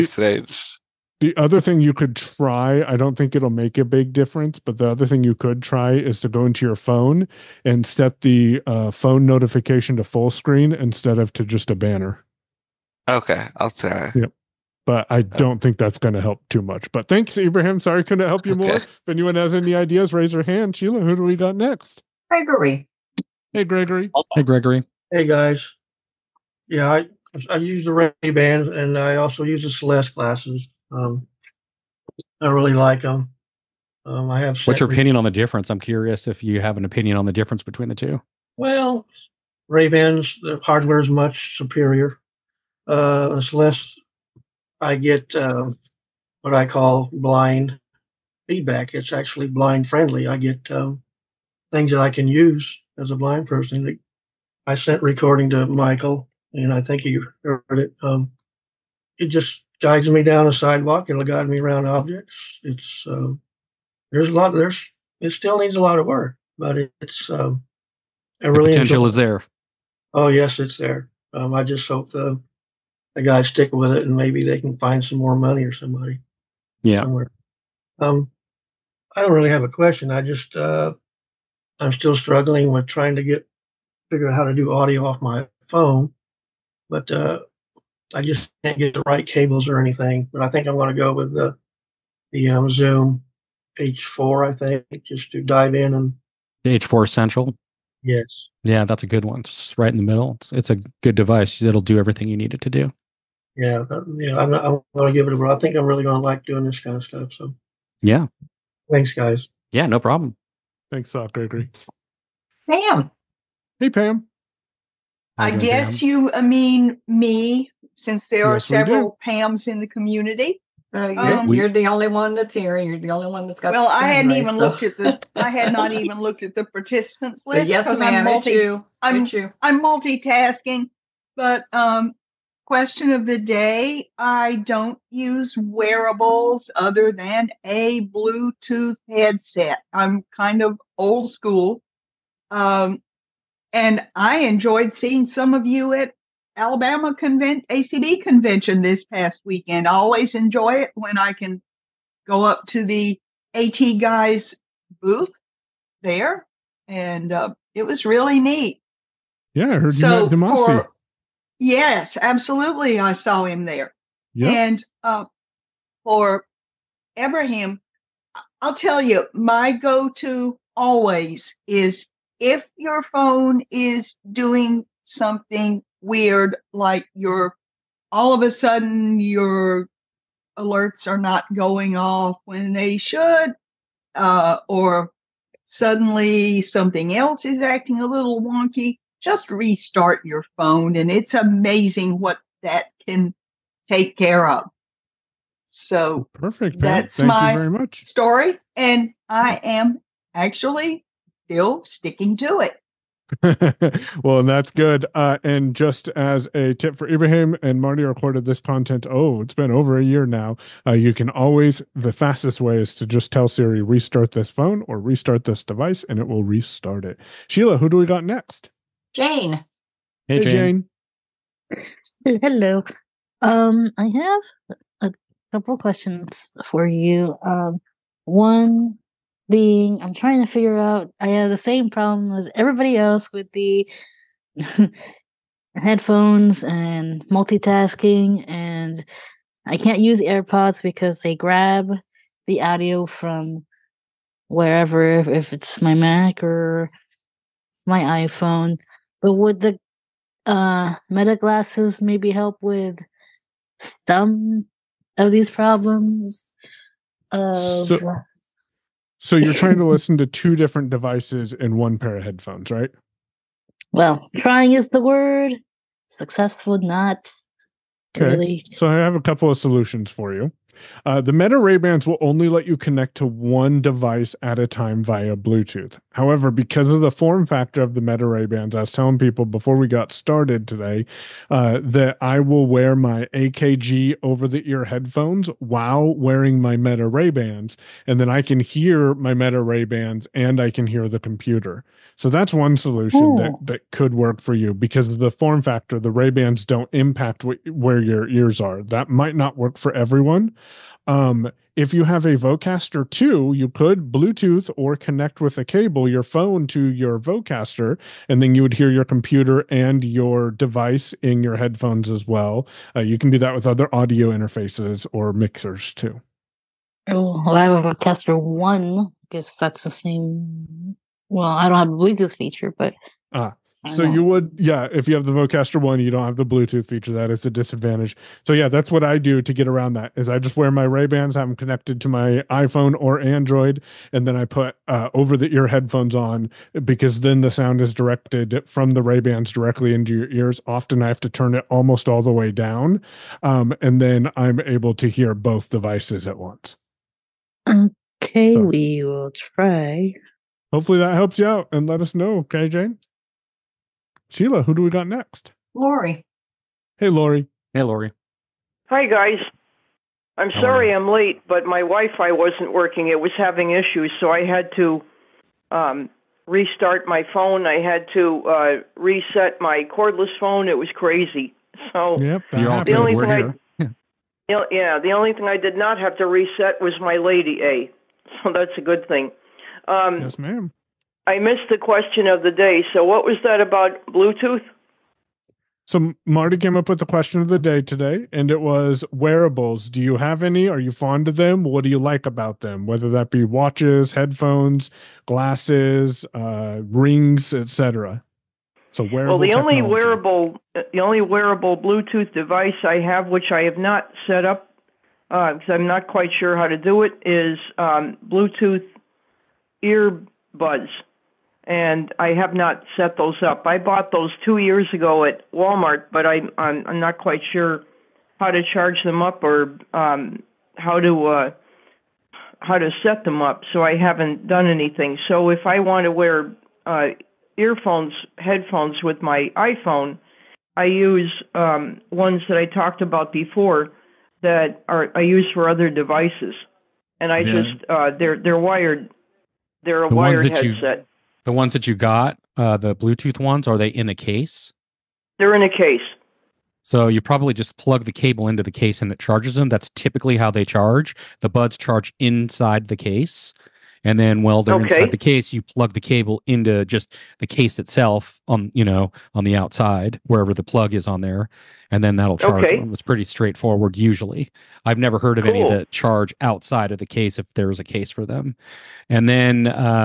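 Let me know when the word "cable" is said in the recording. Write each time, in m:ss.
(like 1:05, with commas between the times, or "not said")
1:29, 5:05, 7:28, 7:35.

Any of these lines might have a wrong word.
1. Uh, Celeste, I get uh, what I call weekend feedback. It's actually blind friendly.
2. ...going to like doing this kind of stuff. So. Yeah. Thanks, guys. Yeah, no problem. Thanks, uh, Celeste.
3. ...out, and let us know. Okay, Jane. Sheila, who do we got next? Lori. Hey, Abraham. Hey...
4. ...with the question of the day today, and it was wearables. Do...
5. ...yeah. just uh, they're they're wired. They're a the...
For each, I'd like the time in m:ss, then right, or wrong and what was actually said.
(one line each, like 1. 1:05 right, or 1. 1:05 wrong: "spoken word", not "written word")
1. 0:42 wrong: "blind", not "weekend"
2. 1:46 wrong: "Gregory", not "Celeste"
3. 5:51 wrong: "Lori", not "Abraham"
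4. 6:26 right
5. 7:17 right.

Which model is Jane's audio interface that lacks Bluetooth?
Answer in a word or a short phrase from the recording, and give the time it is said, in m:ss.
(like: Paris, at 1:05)
Vocaster 1, at 5:17.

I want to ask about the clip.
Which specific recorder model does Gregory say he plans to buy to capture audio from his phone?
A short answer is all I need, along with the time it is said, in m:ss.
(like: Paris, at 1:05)
Zoom H4essential, at 1:36.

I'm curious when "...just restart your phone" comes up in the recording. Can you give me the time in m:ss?
3:09.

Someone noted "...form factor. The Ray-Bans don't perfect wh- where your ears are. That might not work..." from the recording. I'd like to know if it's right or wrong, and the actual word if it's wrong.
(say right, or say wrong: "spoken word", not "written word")
wrong: "impact", not "perfect".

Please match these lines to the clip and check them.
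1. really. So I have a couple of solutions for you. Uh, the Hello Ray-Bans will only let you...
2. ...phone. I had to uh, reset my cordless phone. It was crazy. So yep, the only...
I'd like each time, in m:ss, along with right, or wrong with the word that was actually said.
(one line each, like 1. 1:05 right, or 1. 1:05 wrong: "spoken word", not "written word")
1. 4:28 wrong: "Meta", not "Hello"
2. 6:07 right.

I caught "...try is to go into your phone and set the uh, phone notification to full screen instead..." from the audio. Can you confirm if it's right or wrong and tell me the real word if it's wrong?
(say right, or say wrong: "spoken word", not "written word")
right.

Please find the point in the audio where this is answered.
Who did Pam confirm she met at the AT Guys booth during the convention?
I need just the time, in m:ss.
2:40.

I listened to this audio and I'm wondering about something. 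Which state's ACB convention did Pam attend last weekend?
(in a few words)
Alabama.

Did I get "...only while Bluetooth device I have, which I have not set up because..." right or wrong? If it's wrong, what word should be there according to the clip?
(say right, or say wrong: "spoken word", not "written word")
wrong: "wearable", not "while".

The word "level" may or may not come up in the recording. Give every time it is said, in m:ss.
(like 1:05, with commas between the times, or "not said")
not said.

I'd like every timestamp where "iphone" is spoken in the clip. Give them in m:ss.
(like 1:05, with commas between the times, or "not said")
4:08, 5:32, 7:09.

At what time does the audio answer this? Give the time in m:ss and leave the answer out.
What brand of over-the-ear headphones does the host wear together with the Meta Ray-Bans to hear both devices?
4:43.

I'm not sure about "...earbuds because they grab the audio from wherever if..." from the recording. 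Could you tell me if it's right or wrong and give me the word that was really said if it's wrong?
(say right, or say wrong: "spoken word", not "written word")
wrong: "airpods", not "earbuds".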